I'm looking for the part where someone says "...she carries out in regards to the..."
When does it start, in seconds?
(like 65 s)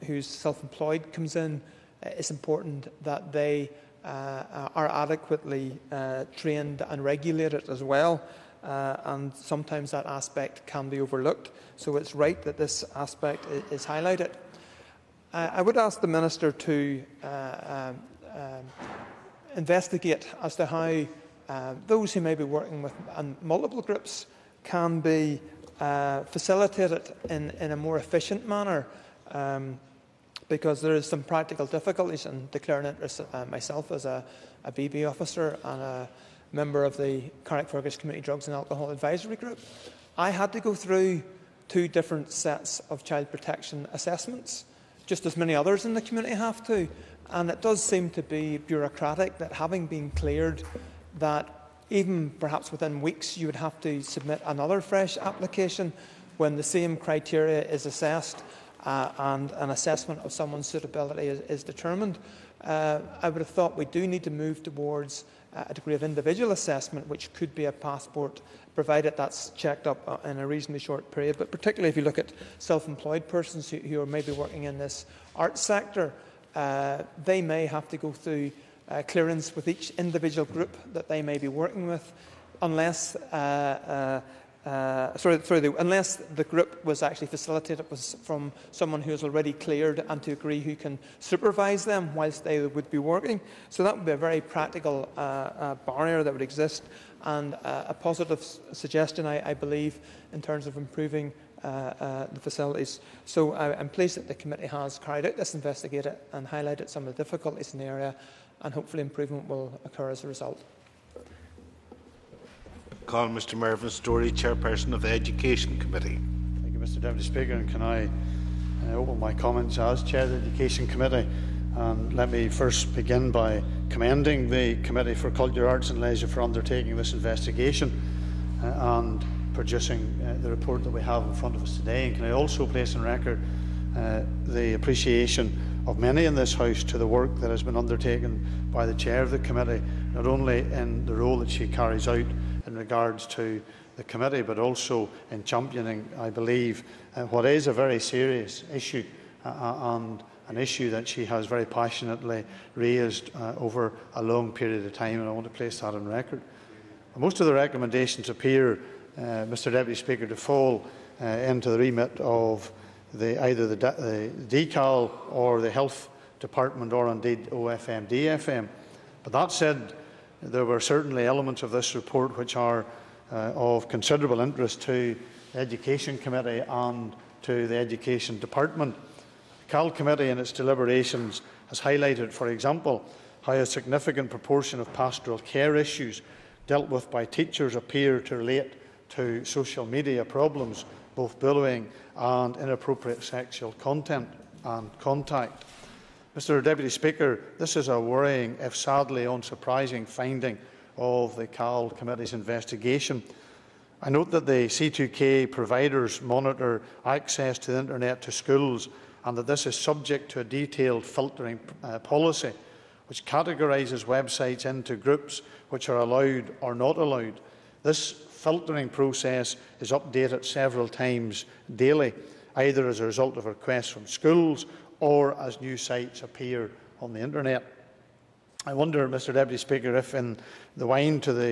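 141 s.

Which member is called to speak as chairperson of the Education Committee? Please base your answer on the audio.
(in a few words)
Mervyn Storey.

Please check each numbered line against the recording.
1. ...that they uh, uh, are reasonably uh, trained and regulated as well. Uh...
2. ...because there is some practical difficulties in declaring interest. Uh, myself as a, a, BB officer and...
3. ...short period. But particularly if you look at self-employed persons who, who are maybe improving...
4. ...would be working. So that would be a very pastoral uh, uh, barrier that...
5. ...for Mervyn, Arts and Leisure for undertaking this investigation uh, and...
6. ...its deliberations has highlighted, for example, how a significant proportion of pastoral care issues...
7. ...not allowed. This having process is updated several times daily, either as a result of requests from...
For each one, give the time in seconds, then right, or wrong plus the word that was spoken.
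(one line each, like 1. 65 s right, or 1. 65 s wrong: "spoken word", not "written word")
1. 3 s wrong: "adequately", not "reasonably"
2. 30 s right
3. 70 s wrong: "working", not "improving"
4. 92 s wrong: "practical", not "pastoral"
5. 125 s wrong: "Culture", not "Mervyn"
6. 180 s right
7. 216 s wrong: "filtering", not "having".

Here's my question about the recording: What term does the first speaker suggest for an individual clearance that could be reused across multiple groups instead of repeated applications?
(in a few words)
passport.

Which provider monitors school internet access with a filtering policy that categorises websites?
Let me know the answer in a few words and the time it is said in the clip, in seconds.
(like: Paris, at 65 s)
C2K, at 204 s.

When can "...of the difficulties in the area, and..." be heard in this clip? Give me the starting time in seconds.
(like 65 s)
107 s.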